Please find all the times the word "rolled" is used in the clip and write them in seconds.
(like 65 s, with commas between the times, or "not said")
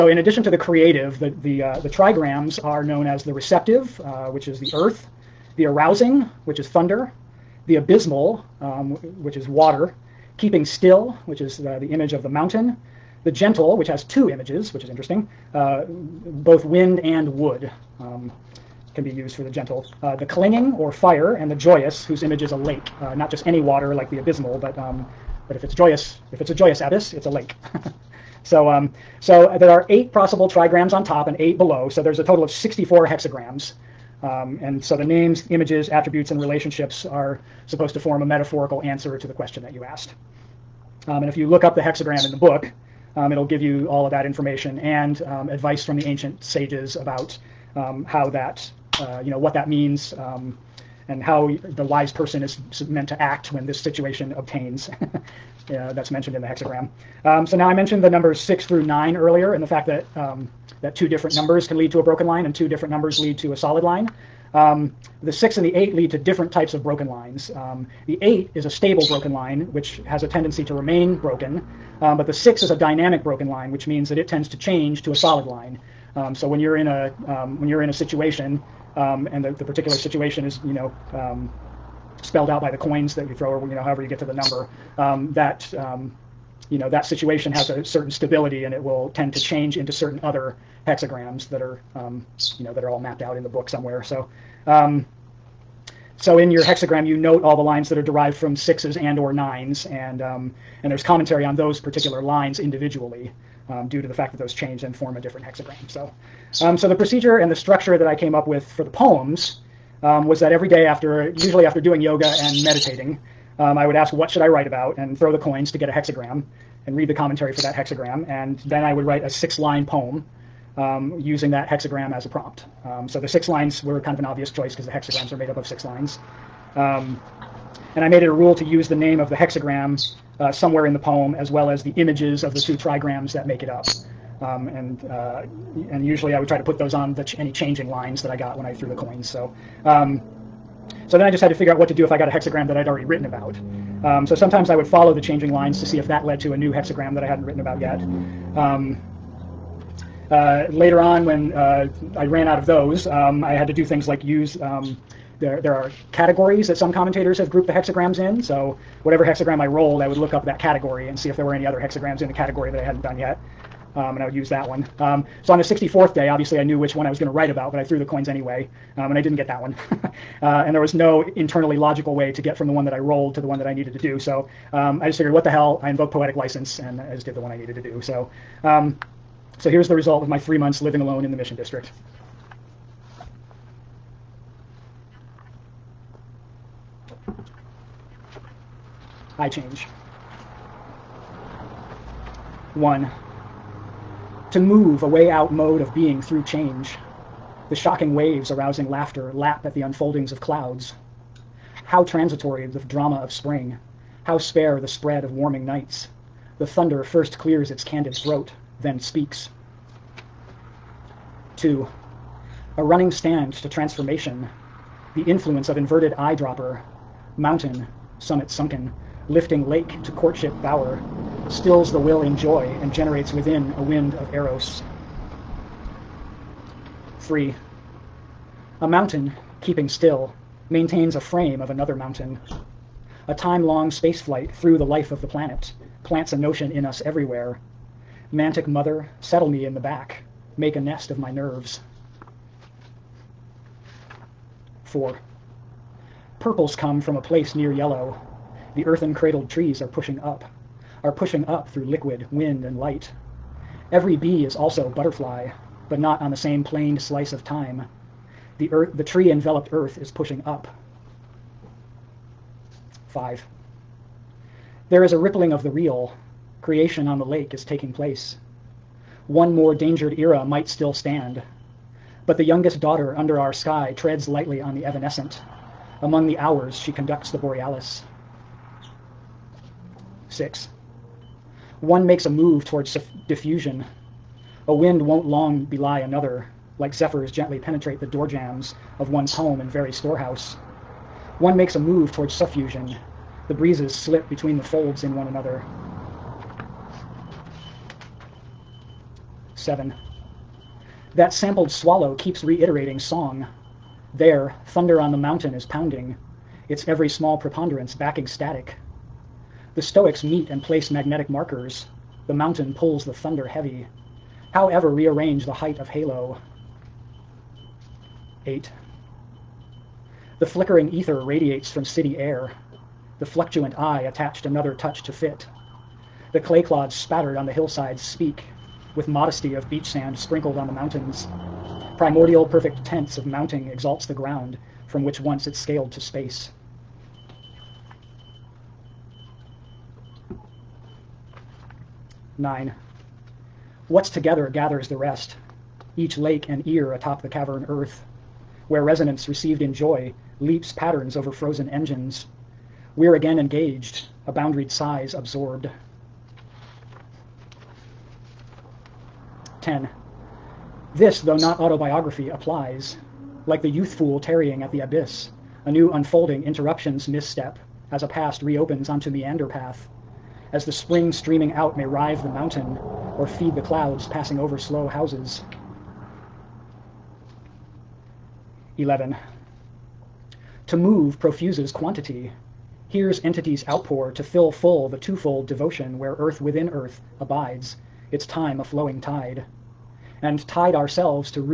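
159 s, 172 s.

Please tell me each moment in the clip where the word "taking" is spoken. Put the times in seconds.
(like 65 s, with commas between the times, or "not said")
267 s.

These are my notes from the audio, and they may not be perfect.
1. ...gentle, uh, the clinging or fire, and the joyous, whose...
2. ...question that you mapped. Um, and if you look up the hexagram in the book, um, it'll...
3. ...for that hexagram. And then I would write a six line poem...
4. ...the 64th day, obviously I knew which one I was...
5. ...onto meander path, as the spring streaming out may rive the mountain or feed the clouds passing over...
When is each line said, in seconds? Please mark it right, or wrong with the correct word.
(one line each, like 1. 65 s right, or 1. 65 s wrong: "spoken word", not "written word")
1. 19 s right
2. 39 s wrong: "asked", not "mapped"
3. 117 s right
4. 165 s right
5. 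368 s right.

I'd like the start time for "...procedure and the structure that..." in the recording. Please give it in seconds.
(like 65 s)
106 s.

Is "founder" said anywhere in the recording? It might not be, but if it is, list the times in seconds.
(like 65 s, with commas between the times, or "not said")
not said.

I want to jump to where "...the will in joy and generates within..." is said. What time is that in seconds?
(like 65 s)
221 s.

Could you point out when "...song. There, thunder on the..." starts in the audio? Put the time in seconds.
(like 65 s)
302 s.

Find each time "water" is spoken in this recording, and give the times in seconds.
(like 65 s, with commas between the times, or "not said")
9 s, 23 s.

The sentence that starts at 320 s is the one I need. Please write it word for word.
The flickering ether radiates from city air.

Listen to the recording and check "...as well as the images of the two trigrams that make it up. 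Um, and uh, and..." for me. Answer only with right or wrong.
right.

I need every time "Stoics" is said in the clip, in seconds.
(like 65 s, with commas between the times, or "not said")
309 s.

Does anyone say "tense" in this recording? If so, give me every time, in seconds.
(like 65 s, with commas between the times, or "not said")
332 s.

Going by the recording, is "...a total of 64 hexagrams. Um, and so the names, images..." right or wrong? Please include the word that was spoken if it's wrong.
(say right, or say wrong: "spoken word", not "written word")
right.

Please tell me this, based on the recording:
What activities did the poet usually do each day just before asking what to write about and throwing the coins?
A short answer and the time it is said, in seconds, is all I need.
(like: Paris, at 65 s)
yoga and meditating, at 112 s.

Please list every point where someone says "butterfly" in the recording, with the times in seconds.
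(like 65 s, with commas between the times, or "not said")
254 s.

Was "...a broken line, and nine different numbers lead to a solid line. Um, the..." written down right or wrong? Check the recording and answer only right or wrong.
wrong.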